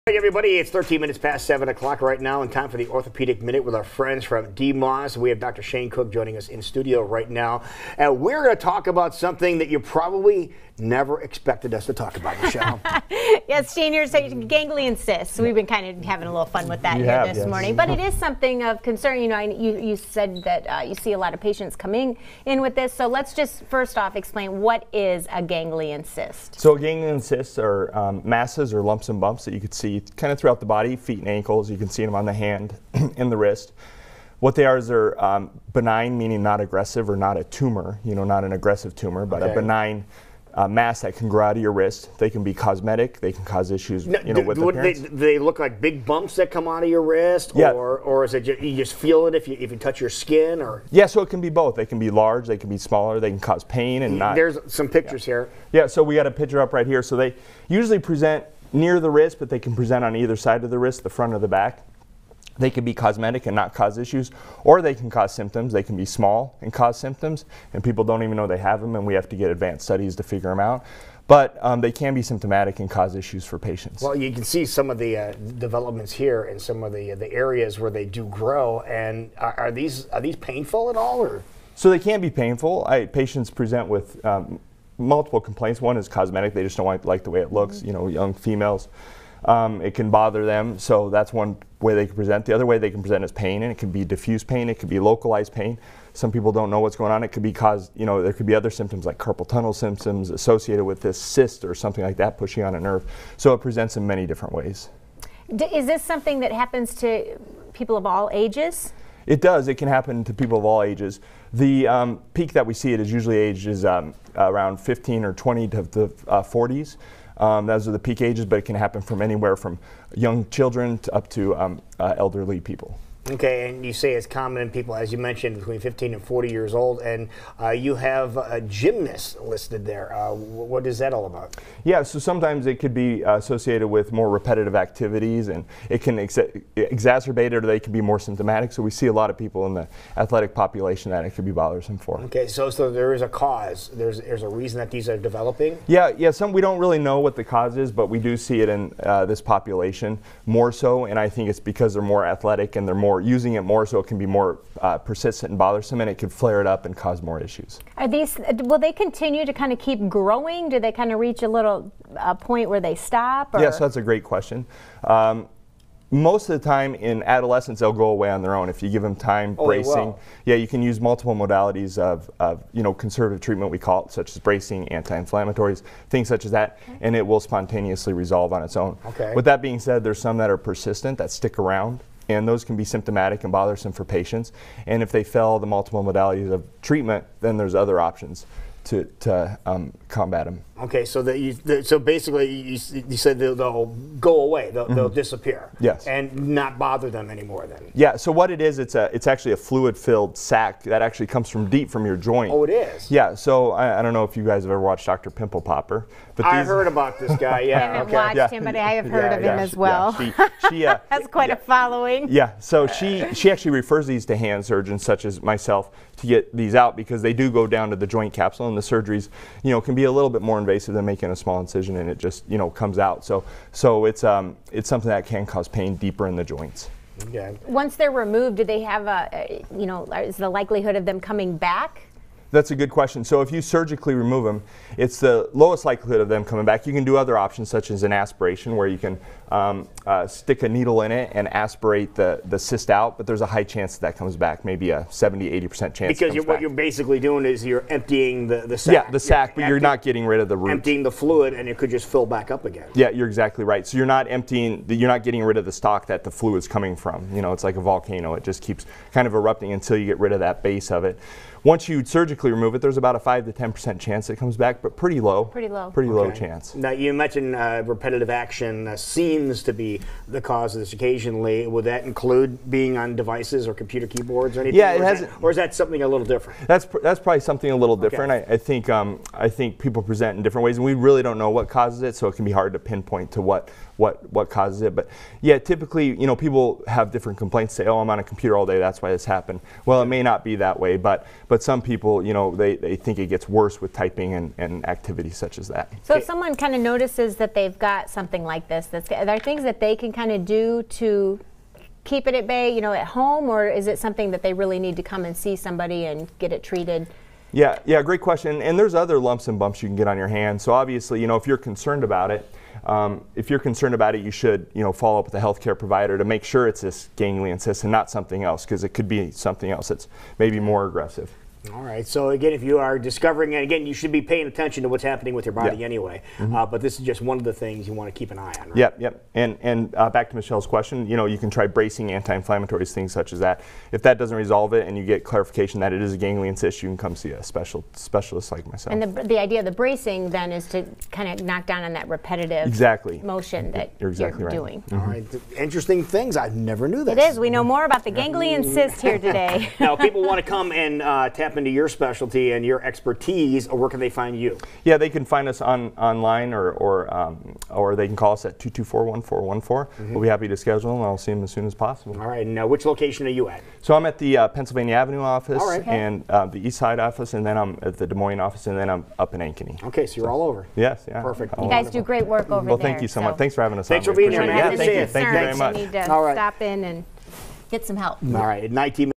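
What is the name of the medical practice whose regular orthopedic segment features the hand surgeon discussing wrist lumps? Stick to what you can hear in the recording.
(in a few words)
DMOS.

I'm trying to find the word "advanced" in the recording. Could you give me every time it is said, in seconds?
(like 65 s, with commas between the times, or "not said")
69 s.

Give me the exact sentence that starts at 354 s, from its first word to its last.
Yeah, they can find us on online, or or um, or they can call us at 224-1414.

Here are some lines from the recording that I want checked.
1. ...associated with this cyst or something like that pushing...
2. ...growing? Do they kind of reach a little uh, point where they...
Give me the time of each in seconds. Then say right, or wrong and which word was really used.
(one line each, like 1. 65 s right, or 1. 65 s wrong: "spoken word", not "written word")
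1. 100 s right
2. 160 s right.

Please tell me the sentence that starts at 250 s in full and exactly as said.
Emptying the fluid and it could just fill back up again.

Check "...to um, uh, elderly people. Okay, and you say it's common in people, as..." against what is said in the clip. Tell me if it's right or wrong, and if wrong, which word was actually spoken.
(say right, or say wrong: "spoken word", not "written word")
right.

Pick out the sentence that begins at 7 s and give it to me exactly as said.
And we're going to talk about something that you probably never expected us to talk about, Michelle.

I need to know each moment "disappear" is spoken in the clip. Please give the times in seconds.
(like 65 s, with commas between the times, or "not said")
195 s.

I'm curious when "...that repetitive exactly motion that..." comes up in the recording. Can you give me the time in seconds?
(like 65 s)
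341 s.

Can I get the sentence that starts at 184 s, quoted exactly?
And if they fail the multiple modalities of treatment, then there's other options to, to um, combat them.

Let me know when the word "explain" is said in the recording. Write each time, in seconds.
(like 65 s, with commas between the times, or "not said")
24 s.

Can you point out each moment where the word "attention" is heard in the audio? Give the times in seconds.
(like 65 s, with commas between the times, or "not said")
324 s.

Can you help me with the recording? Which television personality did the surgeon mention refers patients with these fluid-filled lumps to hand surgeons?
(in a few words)
Doctor Pimple Popper.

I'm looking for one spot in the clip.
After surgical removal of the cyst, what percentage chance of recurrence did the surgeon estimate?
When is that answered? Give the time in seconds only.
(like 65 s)
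263 s.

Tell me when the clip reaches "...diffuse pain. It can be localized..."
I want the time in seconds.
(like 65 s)
94 s.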